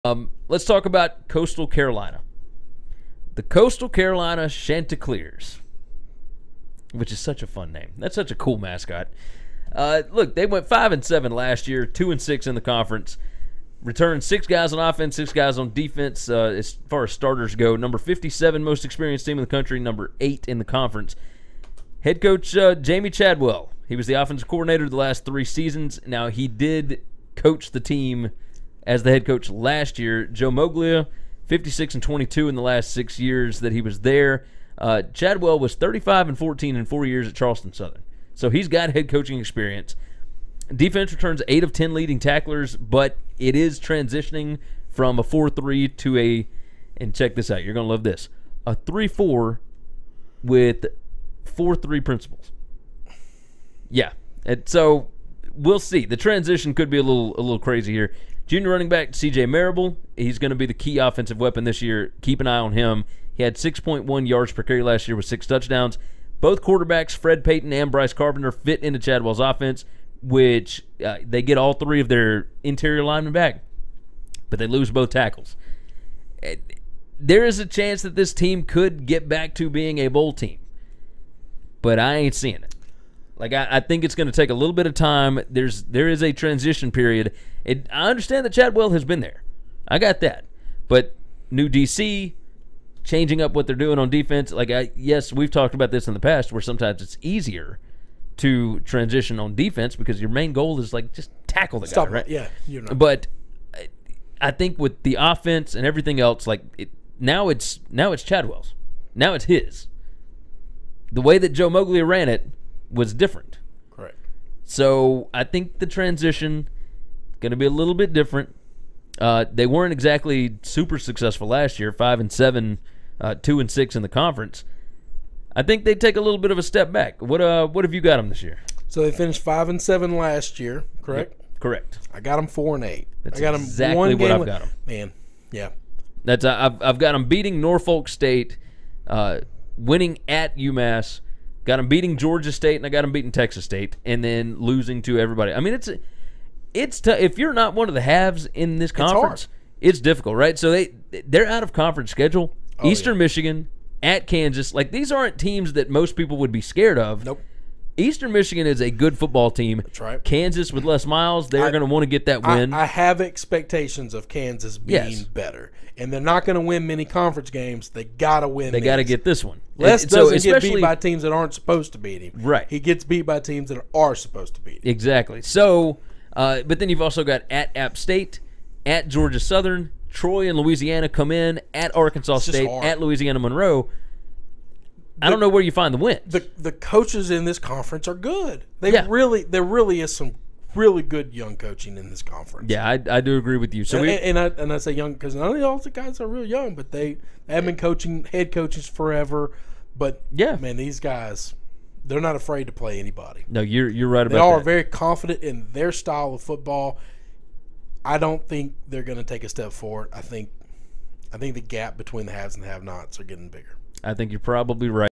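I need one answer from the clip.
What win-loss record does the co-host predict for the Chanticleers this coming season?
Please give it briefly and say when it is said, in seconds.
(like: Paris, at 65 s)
4-8, at 132 s.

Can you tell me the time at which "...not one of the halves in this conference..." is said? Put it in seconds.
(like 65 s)
147 s.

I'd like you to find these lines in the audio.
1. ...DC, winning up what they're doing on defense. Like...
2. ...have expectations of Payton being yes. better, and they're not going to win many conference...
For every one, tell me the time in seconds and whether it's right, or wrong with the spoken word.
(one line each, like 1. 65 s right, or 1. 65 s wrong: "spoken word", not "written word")
1. 91 s wrong: "changing", not "winning"
2. 162 s wrong: "Kansas", not "Payton".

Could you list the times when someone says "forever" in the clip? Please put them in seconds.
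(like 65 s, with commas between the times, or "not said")
198 s.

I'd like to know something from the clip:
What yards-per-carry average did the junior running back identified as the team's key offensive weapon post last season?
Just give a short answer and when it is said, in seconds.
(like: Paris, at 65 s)
6.1, at 63 s.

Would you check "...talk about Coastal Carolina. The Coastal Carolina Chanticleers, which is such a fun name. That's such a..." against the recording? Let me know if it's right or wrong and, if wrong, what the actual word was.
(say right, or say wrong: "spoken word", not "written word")
right.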